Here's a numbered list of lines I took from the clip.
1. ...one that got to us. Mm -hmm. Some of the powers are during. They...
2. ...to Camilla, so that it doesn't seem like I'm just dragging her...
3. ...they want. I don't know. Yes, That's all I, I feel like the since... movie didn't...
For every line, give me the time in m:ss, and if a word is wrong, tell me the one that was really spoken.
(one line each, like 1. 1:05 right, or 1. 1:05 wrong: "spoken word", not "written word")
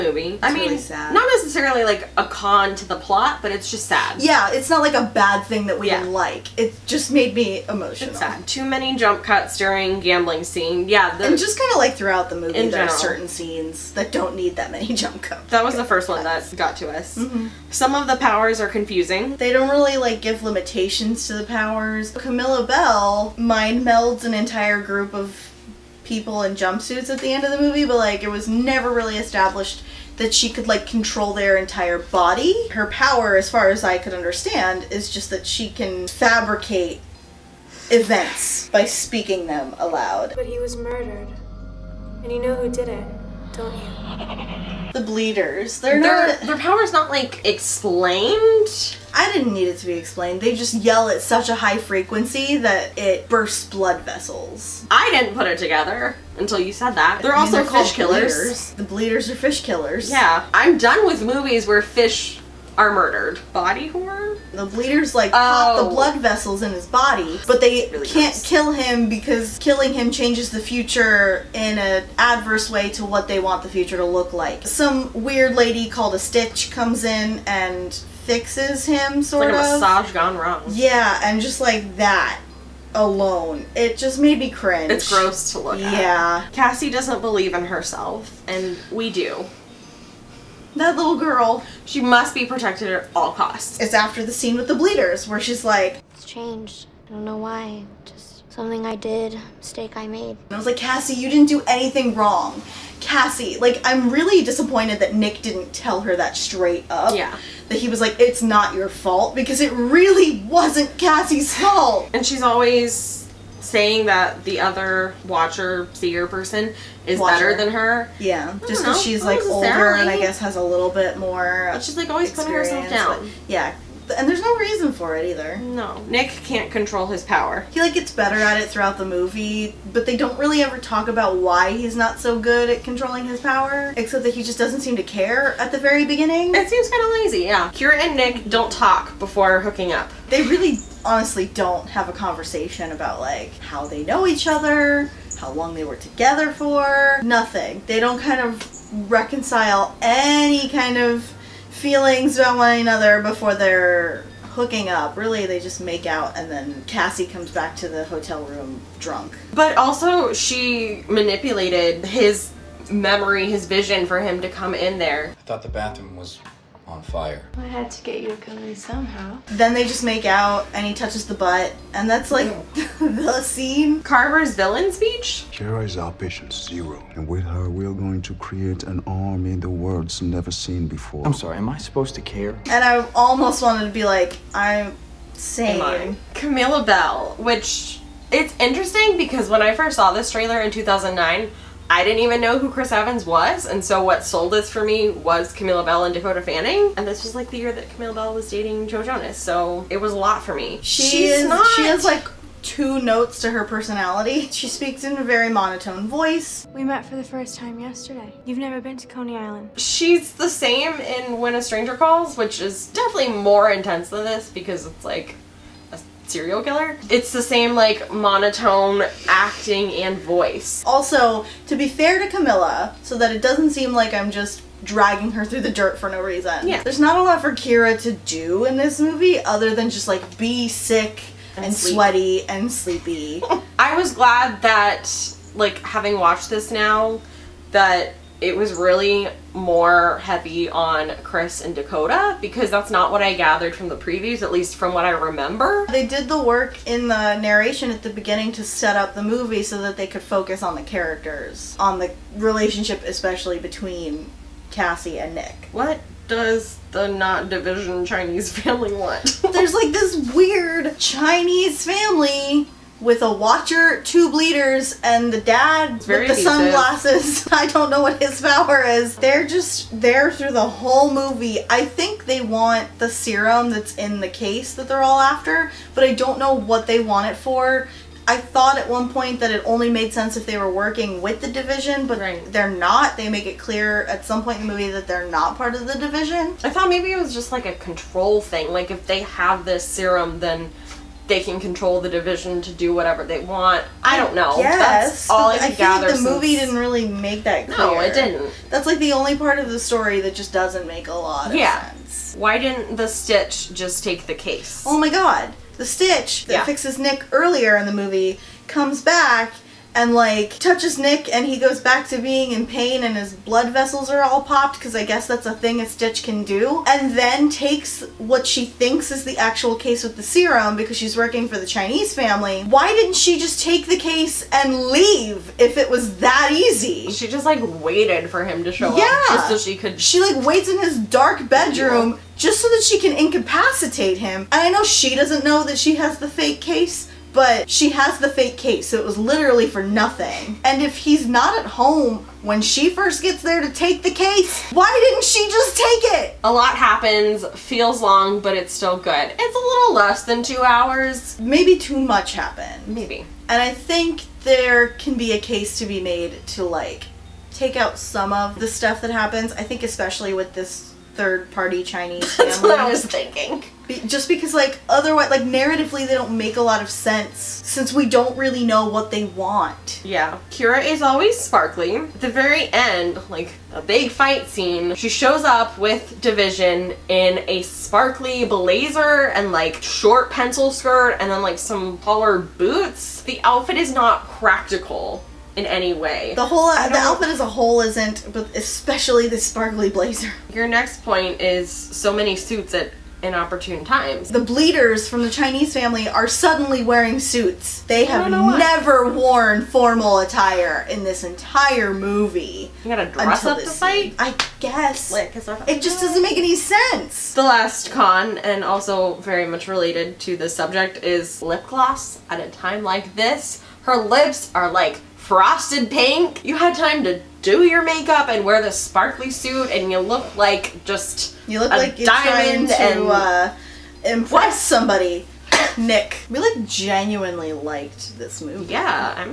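1. 0:16 wrong: "confusing", not "during"
2. 3:42 right
3. 4:53 right.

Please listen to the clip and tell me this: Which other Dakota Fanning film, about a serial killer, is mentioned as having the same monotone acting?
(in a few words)
When a Stranger Calls.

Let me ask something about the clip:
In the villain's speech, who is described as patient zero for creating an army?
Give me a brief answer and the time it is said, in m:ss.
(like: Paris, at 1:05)
Kara, at 2:55.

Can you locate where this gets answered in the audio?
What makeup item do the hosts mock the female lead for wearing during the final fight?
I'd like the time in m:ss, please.
6:51.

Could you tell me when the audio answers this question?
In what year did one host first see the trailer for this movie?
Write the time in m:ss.
3:10.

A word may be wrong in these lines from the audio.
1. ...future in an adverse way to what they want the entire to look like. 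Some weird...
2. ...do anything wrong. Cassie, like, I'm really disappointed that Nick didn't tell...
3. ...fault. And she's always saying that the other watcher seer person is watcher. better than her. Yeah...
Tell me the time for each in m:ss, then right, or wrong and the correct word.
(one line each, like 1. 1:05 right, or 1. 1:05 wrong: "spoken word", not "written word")
1. 1:10 wrong: "future", not "entire"
2. 1:41 right
3. 1:51 right.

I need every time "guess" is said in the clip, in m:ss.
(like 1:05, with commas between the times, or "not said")
2:00, 5:15, 6:44.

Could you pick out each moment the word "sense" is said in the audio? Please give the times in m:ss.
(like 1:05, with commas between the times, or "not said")
4:40, 5:01, 6:06, 6:46.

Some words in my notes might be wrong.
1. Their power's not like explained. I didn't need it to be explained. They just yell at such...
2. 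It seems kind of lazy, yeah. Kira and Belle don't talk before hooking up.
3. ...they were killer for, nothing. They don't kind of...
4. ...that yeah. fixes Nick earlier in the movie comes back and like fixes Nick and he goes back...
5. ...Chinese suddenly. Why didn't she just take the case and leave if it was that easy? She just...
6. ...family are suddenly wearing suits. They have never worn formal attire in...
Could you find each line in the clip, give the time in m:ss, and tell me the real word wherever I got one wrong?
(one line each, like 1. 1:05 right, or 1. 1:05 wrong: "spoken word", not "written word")
1. 0:46 right
2. 2:16 wrong: "Nick", not "Belle"
3. 2:25 wrong: "together", not "killer"
4. 5:06 wrong: "touches", not "fixes"
5. 5:21 wrong: "family", not "suddenly"
6. 6:35 right.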